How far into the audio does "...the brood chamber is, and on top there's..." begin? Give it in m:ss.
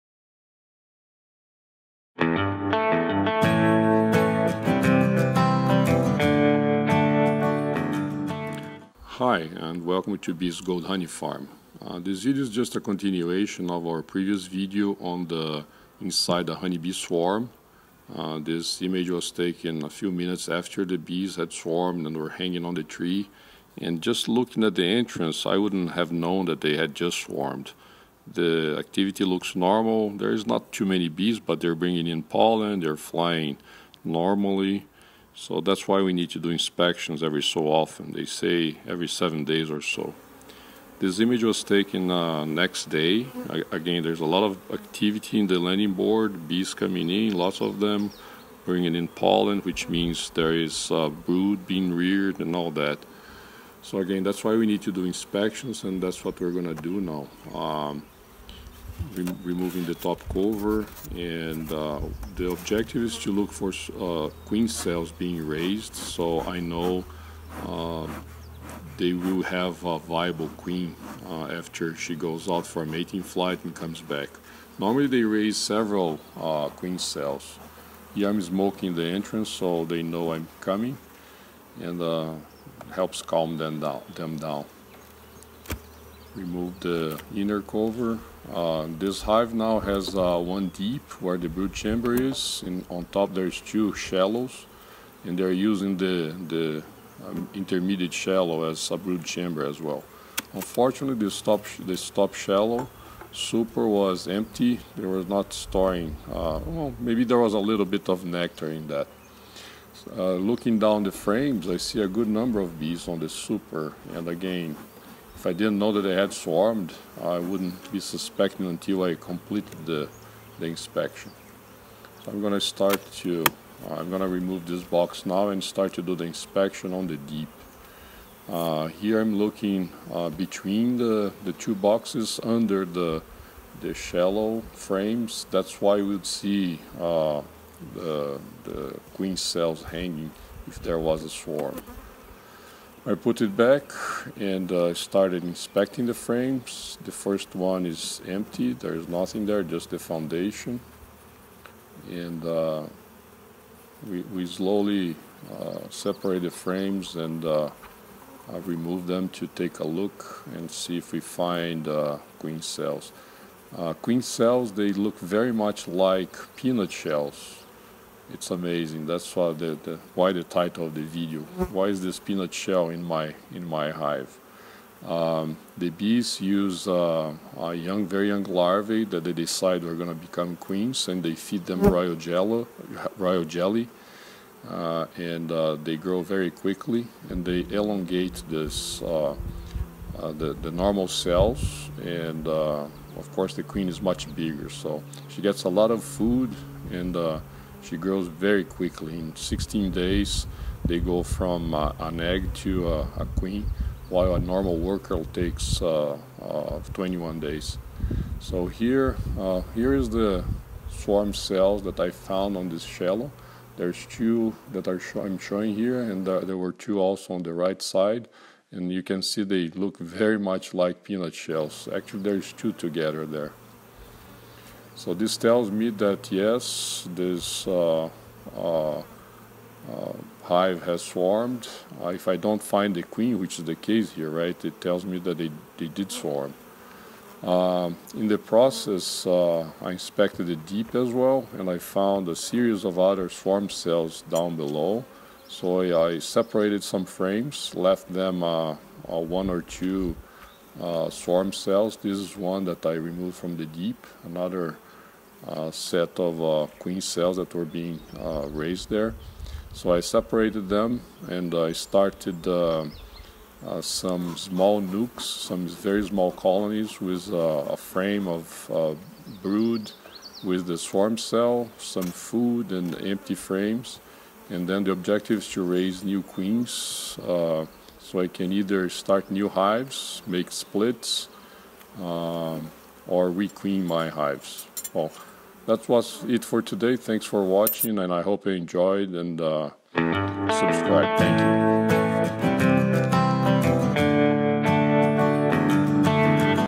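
1:31.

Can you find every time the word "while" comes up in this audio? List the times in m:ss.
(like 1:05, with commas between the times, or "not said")
3:24.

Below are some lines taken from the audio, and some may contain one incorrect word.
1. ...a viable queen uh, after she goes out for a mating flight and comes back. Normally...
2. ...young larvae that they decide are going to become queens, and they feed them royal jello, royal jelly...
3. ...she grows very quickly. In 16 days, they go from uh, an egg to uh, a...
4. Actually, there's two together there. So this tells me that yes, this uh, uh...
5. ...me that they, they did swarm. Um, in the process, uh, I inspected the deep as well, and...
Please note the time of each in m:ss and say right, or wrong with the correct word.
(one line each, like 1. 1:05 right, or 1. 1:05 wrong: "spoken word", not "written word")
1. 1:09 right
2. 2:58 right
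3. 3:17 right
4. 3:41 right
5. 3:55 right.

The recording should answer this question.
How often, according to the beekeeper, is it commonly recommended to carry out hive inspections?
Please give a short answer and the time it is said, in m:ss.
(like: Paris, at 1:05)
every 7 days, at 0:38.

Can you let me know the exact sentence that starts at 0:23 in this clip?
And just looking at the entrance, I wouldn't have known that they had just swarmed.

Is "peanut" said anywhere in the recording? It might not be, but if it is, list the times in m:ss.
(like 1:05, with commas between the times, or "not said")
2:46, 2:52, 3:41.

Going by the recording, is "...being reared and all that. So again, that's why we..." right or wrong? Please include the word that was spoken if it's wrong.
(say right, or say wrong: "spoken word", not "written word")
right.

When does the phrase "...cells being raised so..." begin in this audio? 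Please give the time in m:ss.
1:04.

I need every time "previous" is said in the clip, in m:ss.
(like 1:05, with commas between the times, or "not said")
0:14.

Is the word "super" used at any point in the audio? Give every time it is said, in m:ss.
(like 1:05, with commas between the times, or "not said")
1:43, 1:53.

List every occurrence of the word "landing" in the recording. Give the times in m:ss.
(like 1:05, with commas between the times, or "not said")
0:45.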